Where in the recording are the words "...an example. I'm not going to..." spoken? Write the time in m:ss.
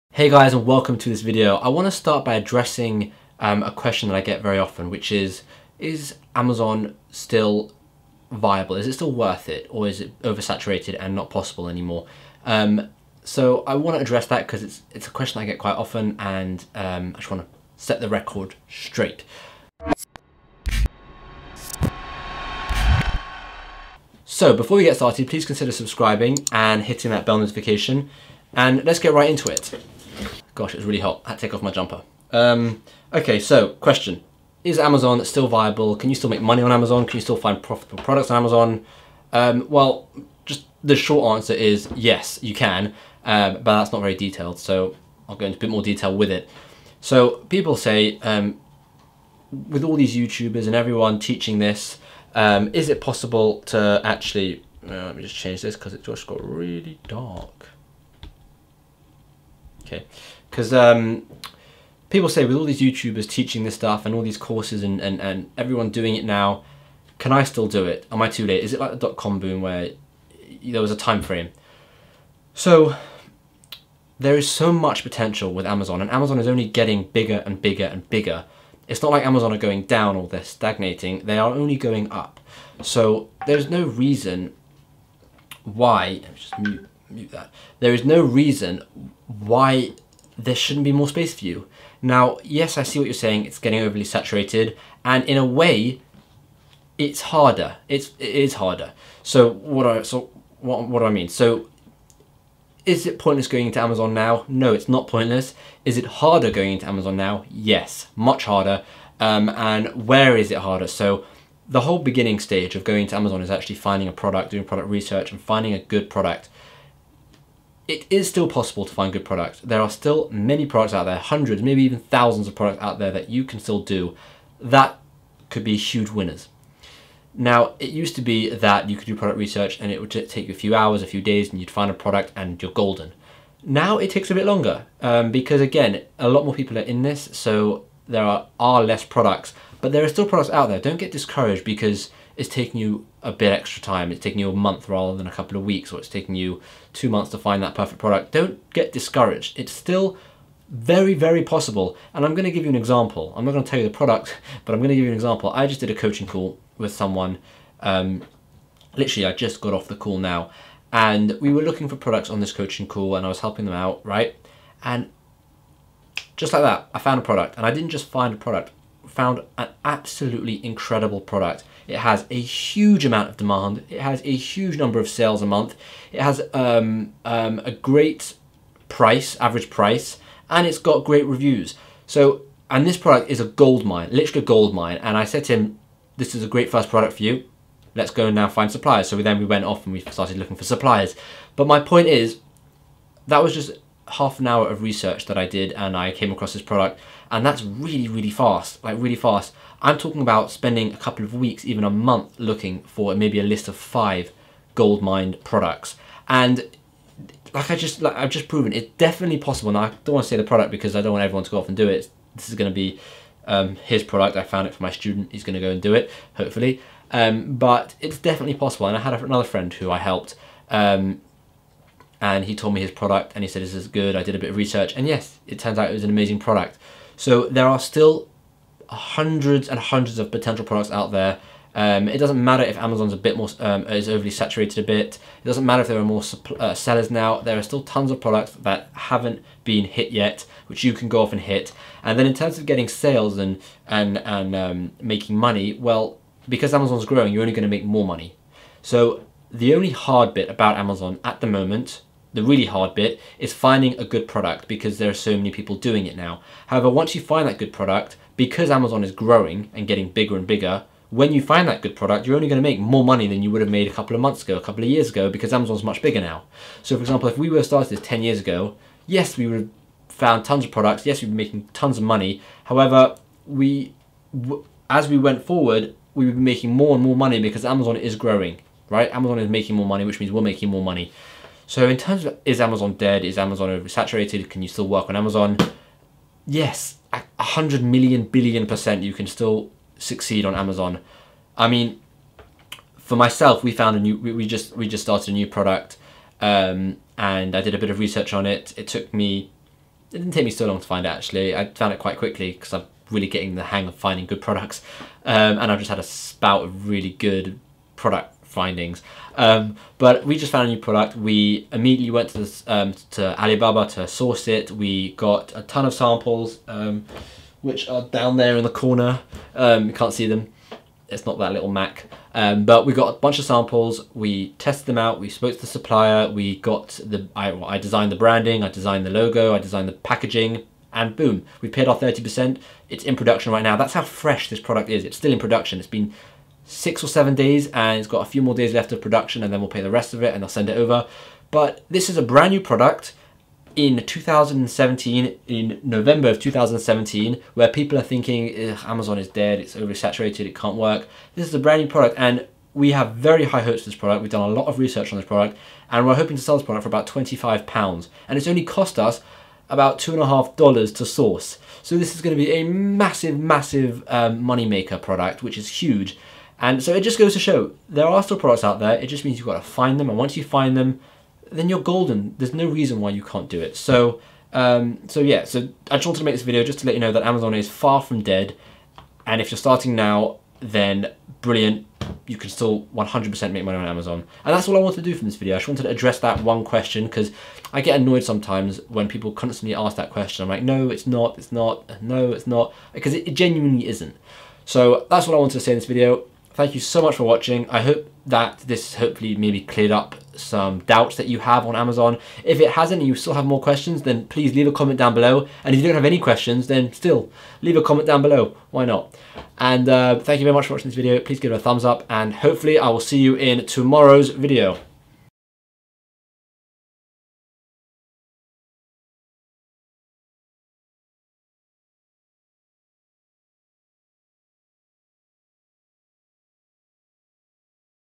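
2:32.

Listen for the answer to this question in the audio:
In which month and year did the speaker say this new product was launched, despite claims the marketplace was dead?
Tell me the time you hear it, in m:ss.
5:45.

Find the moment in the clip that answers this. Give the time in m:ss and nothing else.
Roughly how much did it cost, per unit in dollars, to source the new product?
5:59.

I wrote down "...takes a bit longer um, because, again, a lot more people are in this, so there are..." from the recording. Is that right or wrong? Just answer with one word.
right.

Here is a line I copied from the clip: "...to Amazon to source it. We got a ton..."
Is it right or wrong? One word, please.
wrong.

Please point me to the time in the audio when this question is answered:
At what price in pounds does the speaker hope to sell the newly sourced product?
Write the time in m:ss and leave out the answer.
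5:57.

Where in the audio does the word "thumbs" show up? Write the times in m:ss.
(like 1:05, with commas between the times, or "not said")
6:51.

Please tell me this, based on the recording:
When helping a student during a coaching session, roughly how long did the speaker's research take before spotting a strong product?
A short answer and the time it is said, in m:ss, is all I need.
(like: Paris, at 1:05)
half an hour, at 3:14.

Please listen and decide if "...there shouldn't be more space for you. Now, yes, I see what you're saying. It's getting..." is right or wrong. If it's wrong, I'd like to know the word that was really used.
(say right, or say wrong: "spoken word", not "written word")
right.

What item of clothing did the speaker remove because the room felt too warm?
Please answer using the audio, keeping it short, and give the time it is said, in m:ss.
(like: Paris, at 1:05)
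jumper, at 0:31.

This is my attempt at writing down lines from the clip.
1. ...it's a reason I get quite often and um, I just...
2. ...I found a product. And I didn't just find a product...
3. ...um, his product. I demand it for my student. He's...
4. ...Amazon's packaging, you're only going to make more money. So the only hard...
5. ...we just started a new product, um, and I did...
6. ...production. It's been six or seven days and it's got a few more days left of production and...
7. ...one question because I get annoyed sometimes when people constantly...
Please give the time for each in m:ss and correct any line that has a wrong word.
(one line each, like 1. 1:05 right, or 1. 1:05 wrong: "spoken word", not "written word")
1. 0:14 wrong: "question", not "reason"
2. 2:46 right
3. 3:33 wrong: "found", not "demand"
4. 4:06 wrong: "growing", not "packaging"
5. 4:54 right
6. 5:35 right
7. 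6:26 right.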